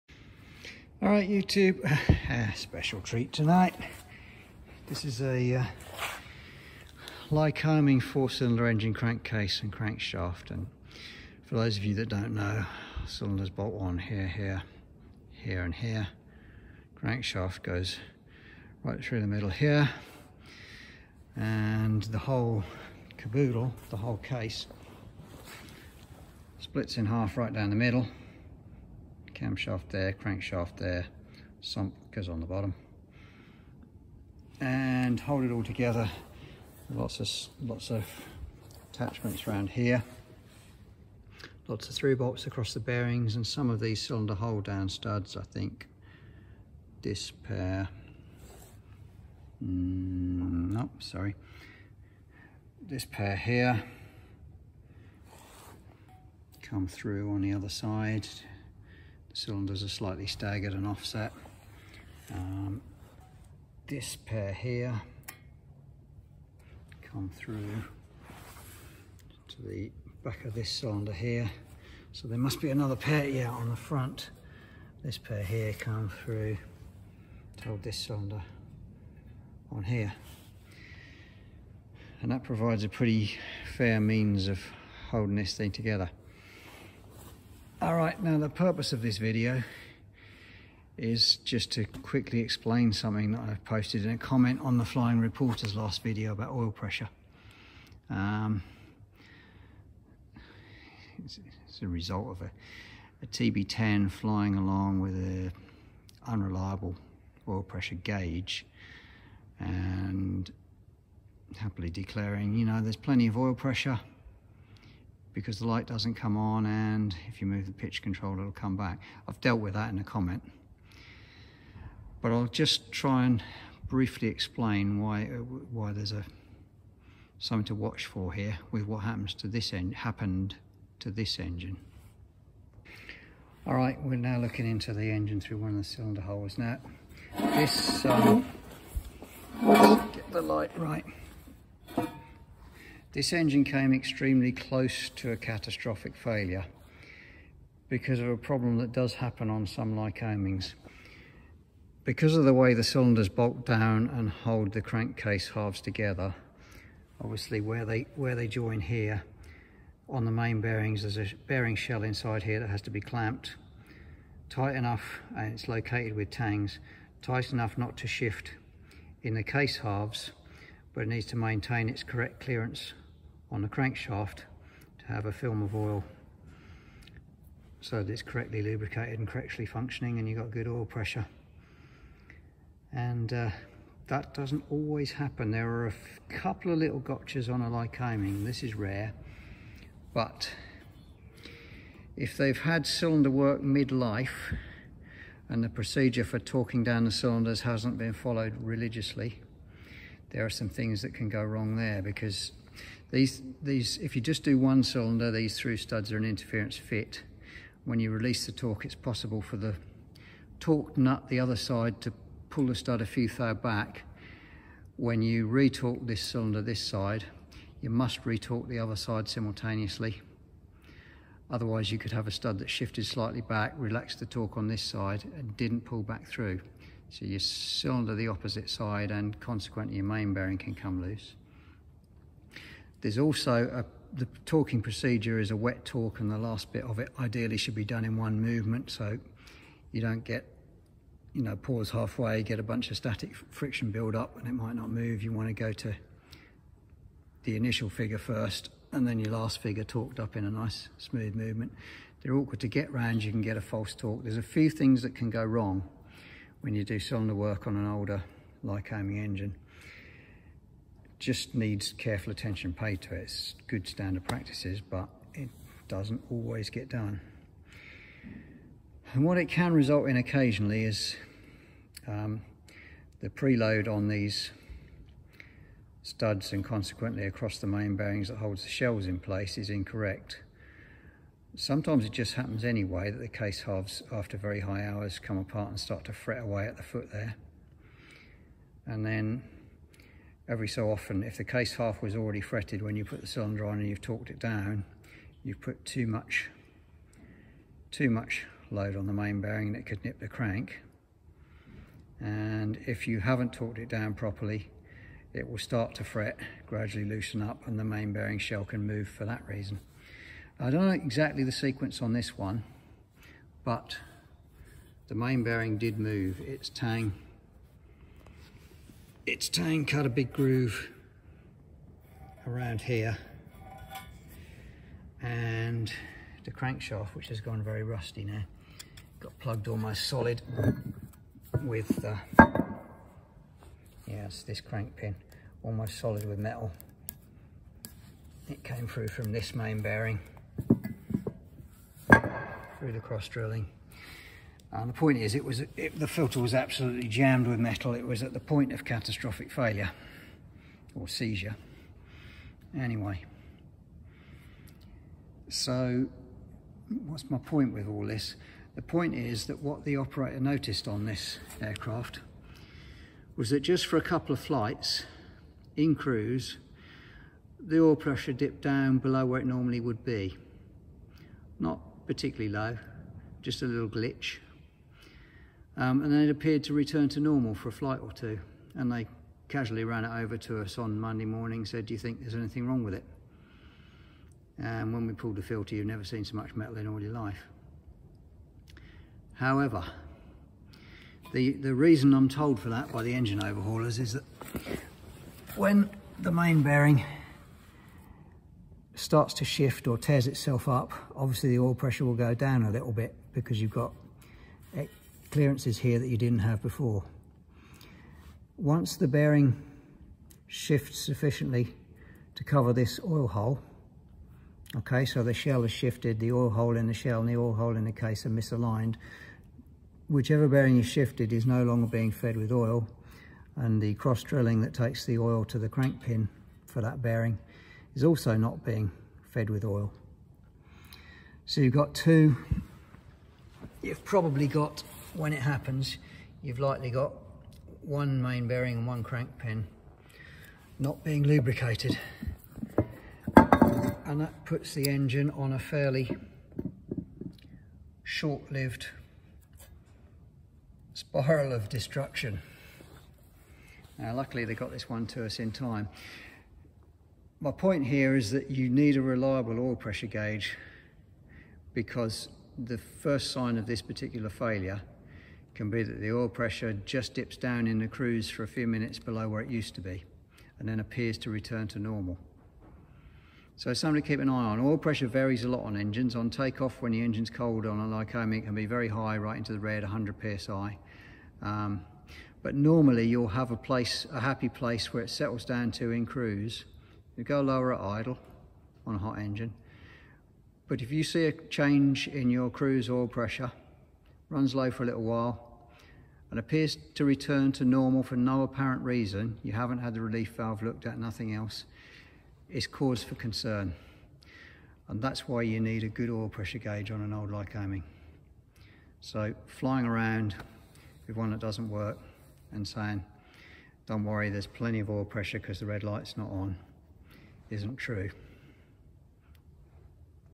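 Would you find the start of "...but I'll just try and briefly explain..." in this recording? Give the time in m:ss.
2:02.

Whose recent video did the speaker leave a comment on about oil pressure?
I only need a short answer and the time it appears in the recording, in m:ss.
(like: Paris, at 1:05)
The Flying Reporter, at 1:34.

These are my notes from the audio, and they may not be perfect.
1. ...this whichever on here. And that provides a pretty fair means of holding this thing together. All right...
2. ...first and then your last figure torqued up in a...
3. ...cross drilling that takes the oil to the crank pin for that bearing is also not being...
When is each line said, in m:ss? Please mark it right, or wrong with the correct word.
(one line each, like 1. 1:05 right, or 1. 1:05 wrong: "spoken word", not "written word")
1. 1:17 wrong: "cylinder", not "whichever"
2. 4:08 right
3. 7:03 right.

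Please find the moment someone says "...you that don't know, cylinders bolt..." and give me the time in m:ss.
0:11.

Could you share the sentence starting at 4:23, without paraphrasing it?
It's good standard practices, but it doesn't always get done.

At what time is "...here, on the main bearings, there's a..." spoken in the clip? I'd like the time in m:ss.
2:38.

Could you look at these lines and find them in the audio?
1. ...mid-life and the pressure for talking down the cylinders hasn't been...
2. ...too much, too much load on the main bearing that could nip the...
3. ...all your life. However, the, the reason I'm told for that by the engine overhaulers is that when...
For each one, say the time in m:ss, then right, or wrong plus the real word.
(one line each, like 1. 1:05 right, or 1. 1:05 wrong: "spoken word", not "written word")
1. 3:13 wrong: "procedure", not "pressure"
2. 4:55 right
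3. 6:26 right.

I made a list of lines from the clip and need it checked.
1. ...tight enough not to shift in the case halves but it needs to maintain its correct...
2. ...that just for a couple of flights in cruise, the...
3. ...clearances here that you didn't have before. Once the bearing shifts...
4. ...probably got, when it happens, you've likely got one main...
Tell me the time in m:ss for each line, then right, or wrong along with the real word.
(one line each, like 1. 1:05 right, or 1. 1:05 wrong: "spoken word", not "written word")
1. 2:47 right
2. 6:03 right
3. 6:45 right
4. 7:14 right.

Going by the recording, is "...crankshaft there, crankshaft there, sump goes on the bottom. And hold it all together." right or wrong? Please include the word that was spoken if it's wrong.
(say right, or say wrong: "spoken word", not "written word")
wrong: "camshaft", not "crankshaft".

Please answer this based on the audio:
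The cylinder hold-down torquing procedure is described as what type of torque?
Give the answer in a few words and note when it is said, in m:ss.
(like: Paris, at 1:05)
Wet torque, at 3:55.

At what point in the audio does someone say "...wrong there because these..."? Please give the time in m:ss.
3:21.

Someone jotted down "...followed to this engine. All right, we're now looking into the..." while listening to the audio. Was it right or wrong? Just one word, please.
wrong.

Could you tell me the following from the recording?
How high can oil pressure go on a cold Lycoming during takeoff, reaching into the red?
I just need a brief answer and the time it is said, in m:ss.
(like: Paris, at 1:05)
100 psi, at 7:59.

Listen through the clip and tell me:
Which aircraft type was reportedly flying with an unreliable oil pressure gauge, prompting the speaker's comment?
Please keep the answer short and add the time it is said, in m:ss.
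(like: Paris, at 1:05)
TB10, at 1:43.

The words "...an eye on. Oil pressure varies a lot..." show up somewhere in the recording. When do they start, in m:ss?
7:54.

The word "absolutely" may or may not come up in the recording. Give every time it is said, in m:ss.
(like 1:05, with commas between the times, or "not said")
5:46.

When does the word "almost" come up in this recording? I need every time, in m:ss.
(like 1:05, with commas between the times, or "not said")
5:29, 5:35.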